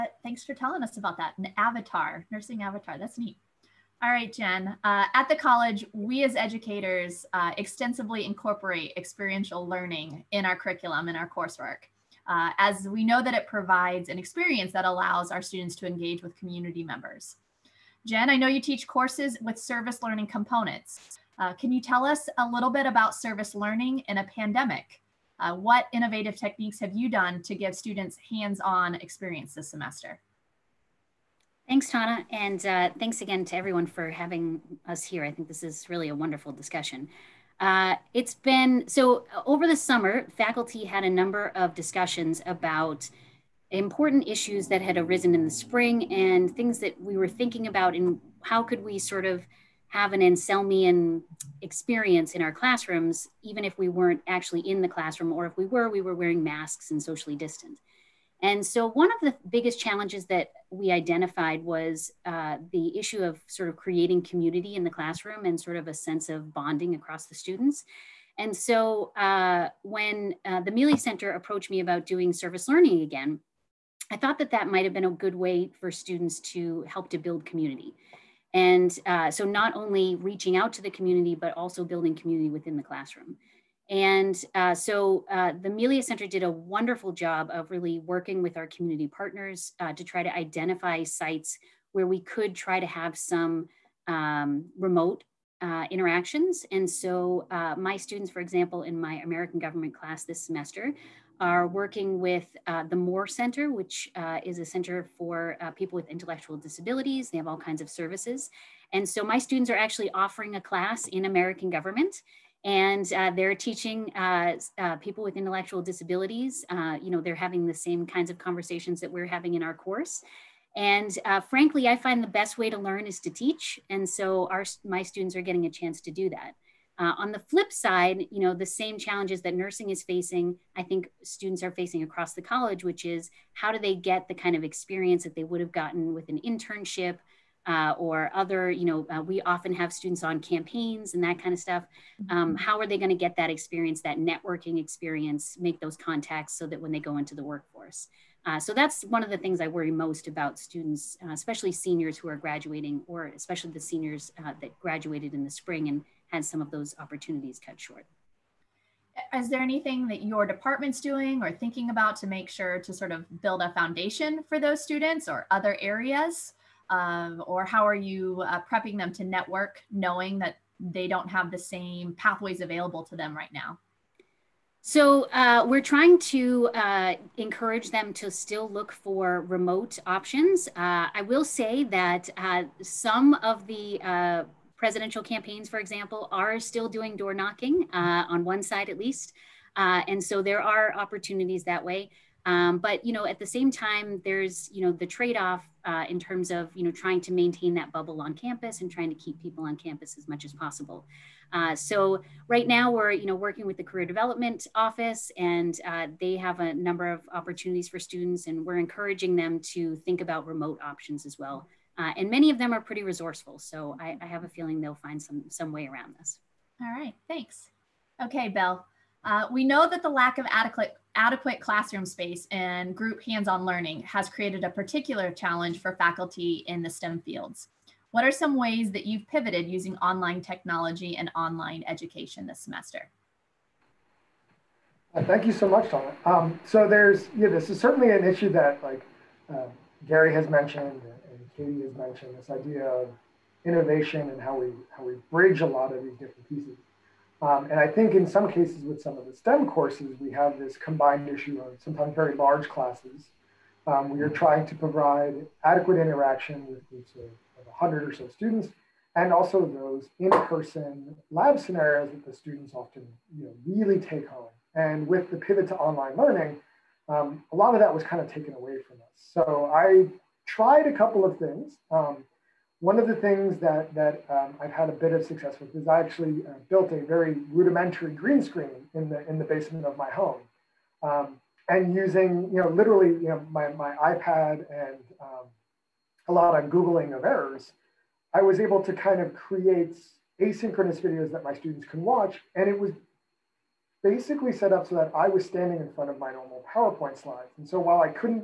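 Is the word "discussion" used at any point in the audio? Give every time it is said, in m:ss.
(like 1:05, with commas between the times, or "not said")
0:36, 0:41.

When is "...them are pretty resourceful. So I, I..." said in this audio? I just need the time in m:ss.
3:32.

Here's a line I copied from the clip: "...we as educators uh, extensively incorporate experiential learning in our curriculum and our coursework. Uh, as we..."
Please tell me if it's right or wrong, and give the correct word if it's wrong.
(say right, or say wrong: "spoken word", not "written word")
right.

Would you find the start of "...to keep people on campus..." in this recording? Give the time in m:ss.
3:19.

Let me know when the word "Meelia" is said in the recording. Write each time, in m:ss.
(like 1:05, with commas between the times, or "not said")
1:10, 1:25.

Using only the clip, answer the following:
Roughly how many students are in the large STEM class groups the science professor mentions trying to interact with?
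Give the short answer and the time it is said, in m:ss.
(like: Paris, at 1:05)
100, at 4:17.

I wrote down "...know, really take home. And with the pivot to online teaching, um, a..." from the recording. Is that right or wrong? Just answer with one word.
wrong.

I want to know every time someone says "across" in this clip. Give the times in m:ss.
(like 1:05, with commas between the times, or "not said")
1:06, 2:12.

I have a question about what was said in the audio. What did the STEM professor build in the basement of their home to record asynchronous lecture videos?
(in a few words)
green screen.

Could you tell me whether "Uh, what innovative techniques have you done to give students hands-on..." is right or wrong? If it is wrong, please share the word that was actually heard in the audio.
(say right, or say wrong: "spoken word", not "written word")
right.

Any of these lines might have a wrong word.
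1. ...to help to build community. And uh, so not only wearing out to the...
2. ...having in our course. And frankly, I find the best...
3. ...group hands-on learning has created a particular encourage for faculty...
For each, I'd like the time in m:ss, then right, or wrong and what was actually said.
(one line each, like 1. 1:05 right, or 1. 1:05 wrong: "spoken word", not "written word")
1. 1:16 wrong: "reaching", not "wearing"
2. 1:59 right
3. 3:42 wrong: "challenge", not "encourage".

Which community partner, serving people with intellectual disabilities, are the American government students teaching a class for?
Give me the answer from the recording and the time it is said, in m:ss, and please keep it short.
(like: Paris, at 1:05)
Moore Center, at 1:42.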